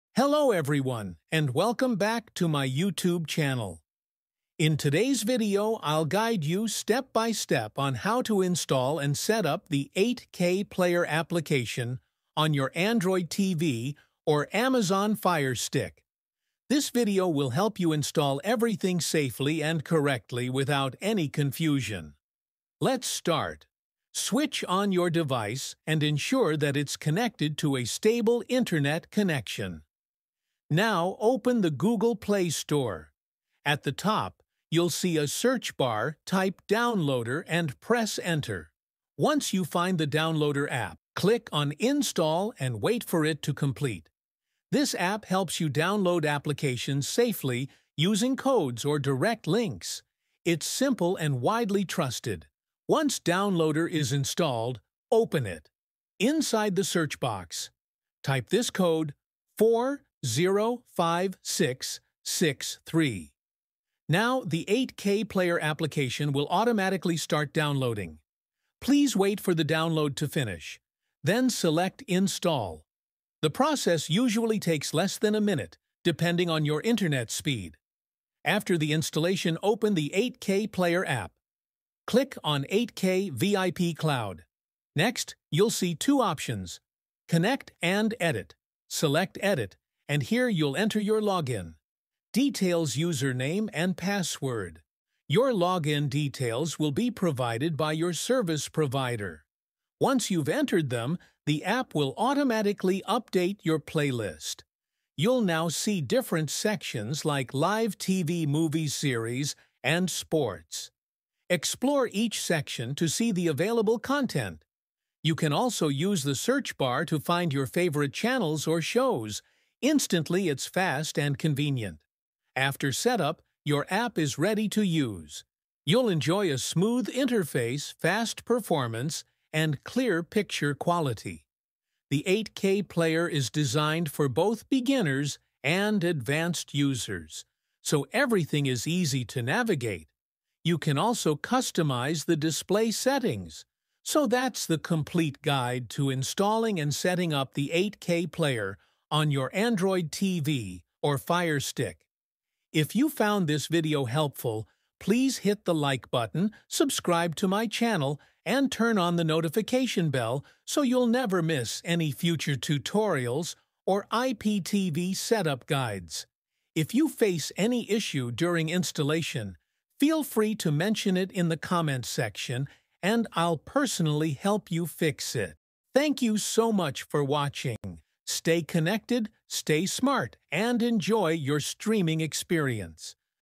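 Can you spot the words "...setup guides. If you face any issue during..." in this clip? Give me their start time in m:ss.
2:45.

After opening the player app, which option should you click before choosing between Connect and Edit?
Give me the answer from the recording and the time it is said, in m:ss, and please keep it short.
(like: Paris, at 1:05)
8K VIP Cloud, at 1:22.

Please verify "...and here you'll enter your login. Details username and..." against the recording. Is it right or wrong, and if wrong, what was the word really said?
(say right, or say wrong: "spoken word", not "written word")
right.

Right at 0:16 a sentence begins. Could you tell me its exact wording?
This video will help you install everything safely and correctly without any confusion.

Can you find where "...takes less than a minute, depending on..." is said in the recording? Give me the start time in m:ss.
1:14.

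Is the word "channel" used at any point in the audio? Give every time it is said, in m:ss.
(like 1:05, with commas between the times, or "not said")
0:03, 1:58, 2:37.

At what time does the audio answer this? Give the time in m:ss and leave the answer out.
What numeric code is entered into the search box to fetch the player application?
0:59.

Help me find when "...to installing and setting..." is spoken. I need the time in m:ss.
2:25.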